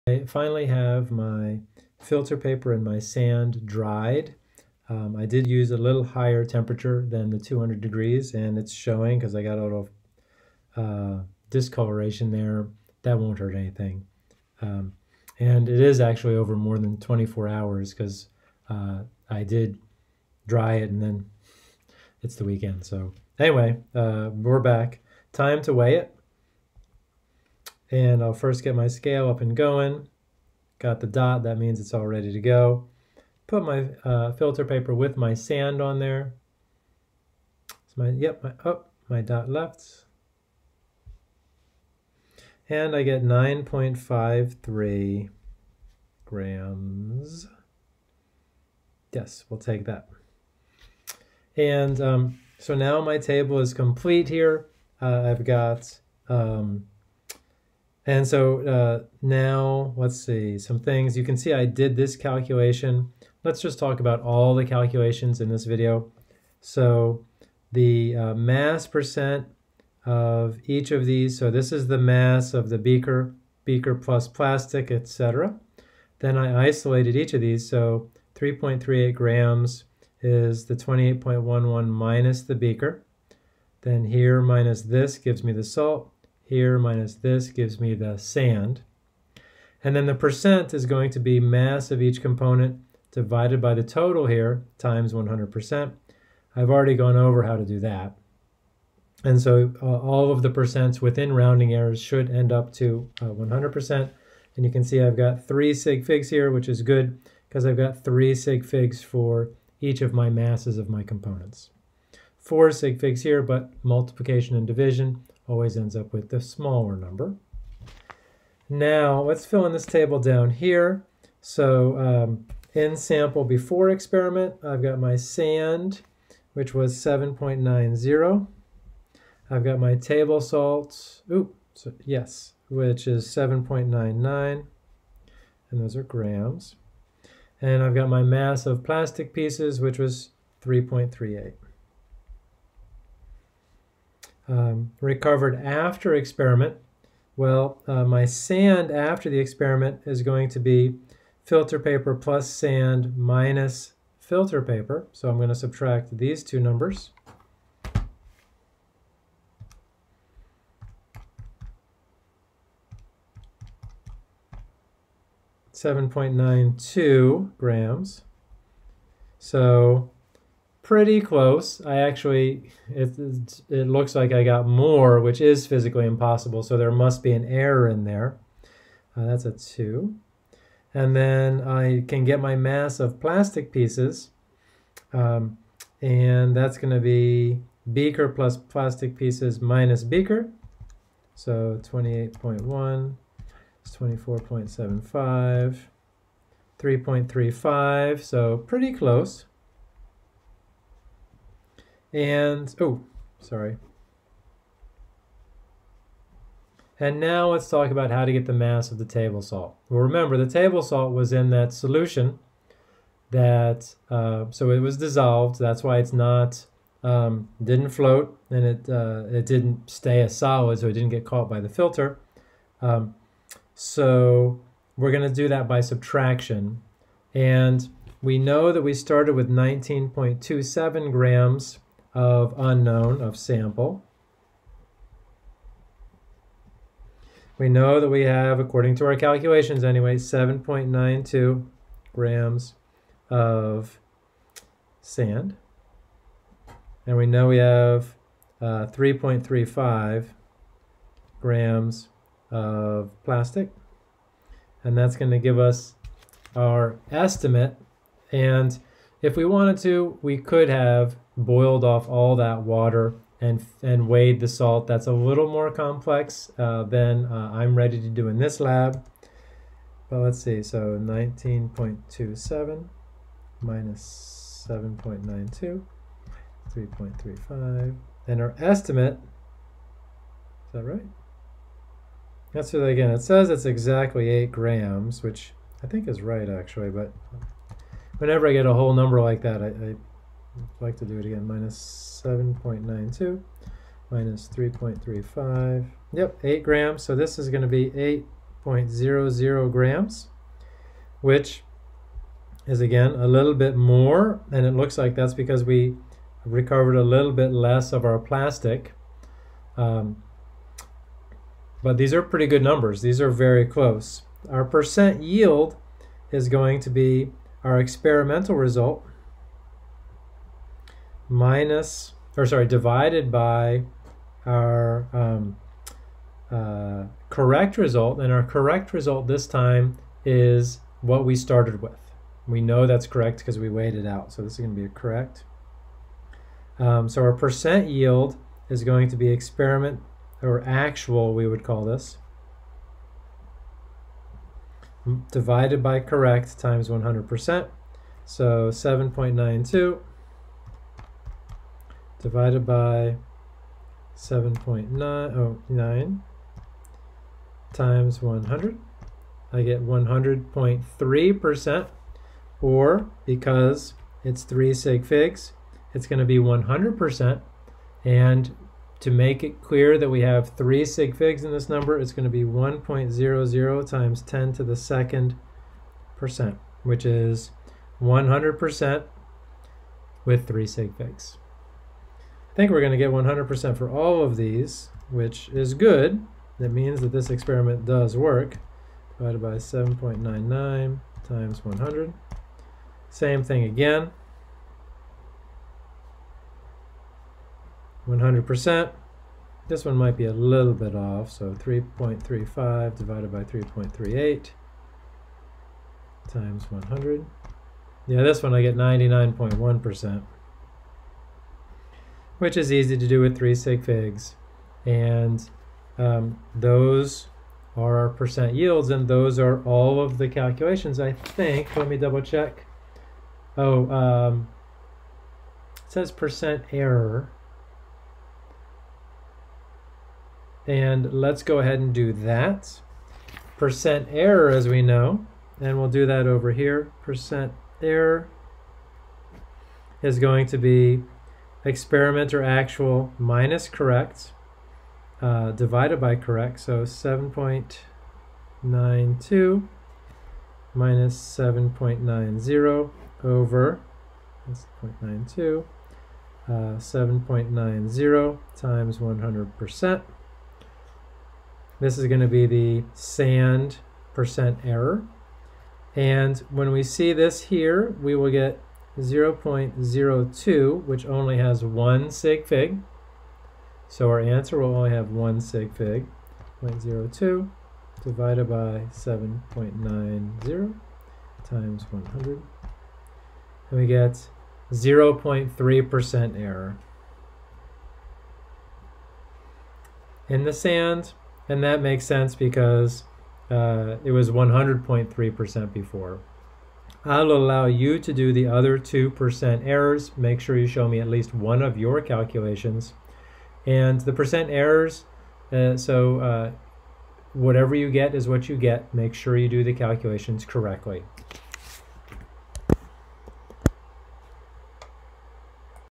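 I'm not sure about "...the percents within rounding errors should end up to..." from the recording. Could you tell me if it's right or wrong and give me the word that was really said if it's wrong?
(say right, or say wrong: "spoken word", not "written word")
right.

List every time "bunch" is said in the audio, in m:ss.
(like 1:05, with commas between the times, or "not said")
not said.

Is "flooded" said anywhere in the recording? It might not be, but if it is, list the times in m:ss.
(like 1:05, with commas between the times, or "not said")
not said.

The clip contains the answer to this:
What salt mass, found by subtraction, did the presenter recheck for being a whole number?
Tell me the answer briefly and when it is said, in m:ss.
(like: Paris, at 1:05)
8.00 grams, at 4:58.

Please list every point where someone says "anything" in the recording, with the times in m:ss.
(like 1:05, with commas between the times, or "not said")
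0:13.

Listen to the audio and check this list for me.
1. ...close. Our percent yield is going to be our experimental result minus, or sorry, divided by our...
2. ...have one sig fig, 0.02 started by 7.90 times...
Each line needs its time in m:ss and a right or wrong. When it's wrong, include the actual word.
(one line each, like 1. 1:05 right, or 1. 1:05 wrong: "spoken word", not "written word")
1. 5:13 right
2. 7:54 wrong: "divided", not "started".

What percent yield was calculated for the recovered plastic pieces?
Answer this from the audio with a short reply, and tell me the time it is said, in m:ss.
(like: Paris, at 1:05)
99.1%, at 6:48.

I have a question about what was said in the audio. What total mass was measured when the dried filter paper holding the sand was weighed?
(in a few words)
9.53 grams.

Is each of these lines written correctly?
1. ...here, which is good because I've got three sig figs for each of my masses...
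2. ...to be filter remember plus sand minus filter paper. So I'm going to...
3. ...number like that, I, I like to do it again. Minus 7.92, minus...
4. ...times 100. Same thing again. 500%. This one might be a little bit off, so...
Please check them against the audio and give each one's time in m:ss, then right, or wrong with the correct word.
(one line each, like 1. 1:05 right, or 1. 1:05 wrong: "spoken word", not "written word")
1. 1:46 right
2. 2:30 wrong: "paper", not "remember"
3. 4:48 right
4. 6:31 wrong: "100", not "500".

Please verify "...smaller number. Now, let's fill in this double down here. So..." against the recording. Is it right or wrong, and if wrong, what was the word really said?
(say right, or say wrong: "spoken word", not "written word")
wrong: "table", not "double".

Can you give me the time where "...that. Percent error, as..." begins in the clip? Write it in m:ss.
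7:12.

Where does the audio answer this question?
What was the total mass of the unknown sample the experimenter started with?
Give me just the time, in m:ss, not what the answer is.
3:49.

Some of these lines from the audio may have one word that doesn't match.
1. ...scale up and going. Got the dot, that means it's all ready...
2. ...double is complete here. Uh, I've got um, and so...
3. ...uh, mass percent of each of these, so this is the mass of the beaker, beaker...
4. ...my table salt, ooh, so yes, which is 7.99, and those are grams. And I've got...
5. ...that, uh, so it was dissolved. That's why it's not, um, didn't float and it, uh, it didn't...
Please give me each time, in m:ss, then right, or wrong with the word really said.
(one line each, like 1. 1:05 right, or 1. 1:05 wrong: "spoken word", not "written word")
1. 0:28 right
2. 0:53 wrong: "table", not "double"
3. 1:08 right
4. 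2:09 right
5. 3:33 right.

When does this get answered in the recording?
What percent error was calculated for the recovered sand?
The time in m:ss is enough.
8:04.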